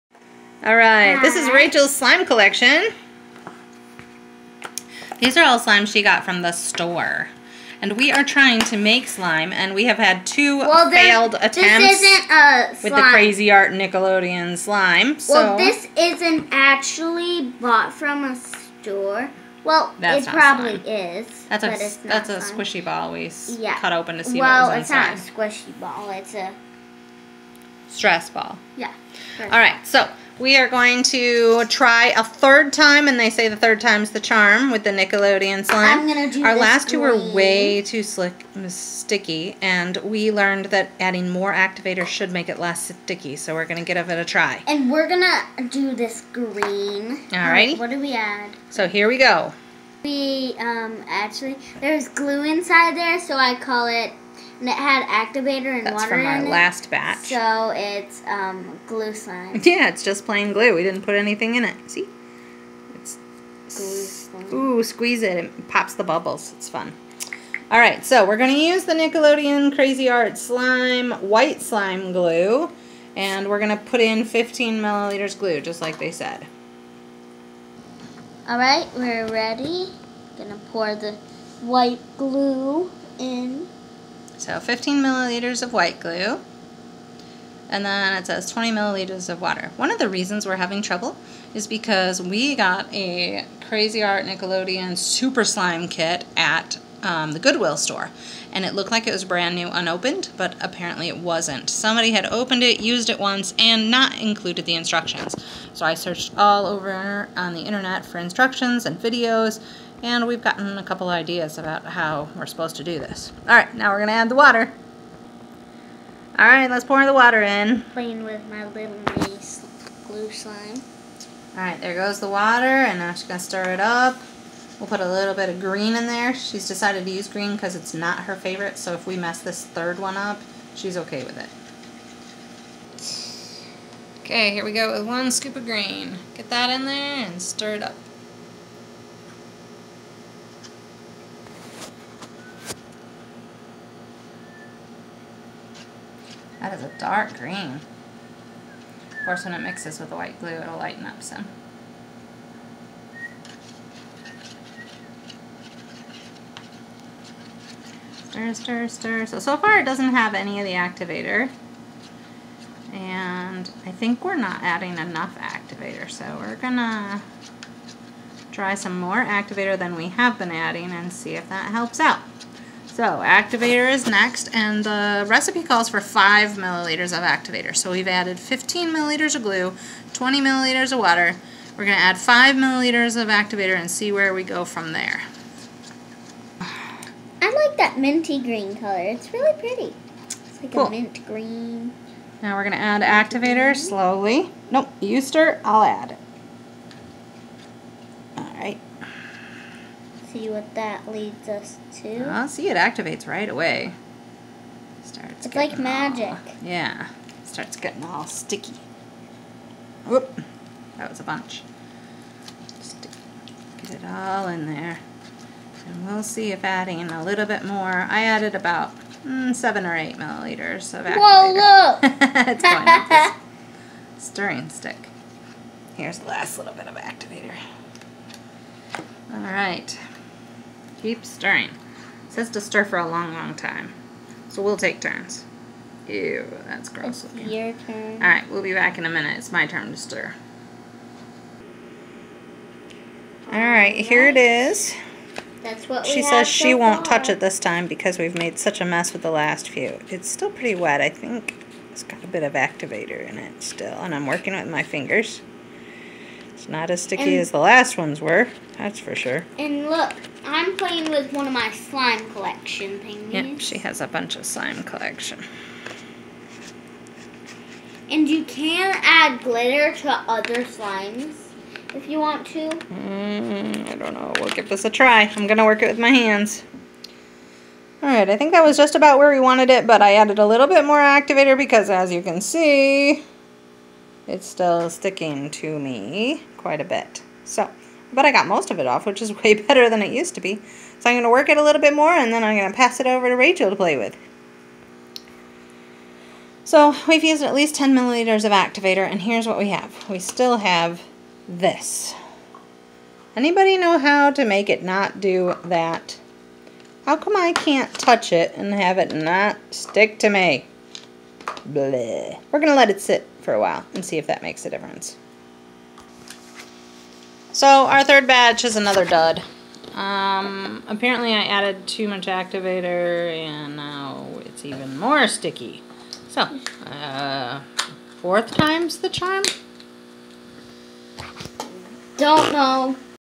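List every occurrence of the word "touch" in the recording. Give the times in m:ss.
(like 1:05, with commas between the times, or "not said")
4:07, 5:07.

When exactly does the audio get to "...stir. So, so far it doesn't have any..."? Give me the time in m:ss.
2:38.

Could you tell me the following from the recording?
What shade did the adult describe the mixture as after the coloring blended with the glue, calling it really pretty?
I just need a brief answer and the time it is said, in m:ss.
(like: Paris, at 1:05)
Mint green, at 3:10.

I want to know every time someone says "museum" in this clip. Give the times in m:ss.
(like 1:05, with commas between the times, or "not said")
not said.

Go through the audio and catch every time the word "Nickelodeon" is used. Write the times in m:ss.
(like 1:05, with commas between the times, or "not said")
0:13, 0:34, 1:08, 1:34.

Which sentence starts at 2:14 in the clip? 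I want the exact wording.
Okay, here we go with one scoop of green.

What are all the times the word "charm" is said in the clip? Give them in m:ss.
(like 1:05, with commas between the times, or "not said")
0:34, 5:29.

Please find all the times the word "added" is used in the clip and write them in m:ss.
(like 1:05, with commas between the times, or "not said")
2:58, 3:38, 4:40, 5:21.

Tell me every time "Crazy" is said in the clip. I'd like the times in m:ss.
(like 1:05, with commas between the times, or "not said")
0:13, 1:09, 1:33.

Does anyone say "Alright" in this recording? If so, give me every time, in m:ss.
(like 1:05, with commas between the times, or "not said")
3:58, 4:03, 4:38.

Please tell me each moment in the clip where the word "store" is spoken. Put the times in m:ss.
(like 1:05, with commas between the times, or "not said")
0:06, 0:18, 1:37.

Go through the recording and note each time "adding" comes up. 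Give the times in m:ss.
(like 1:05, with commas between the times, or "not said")
0:40, 2:44, 2:50, 3:36.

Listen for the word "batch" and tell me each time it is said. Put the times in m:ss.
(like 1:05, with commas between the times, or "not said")
0:56, 5:18.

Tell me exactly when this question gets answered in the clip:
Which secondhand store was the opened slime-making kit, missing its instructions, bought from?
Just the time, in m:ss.
1:37.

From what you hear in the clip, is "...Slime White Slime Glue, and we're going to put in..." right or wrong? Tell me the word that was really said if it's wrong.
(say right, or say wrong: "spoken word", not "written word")
right.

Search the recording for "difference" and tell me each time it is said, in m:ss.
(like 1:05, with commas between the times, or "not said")
5:14.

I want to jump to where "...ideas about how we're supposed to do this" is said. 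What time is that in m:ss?
1:51.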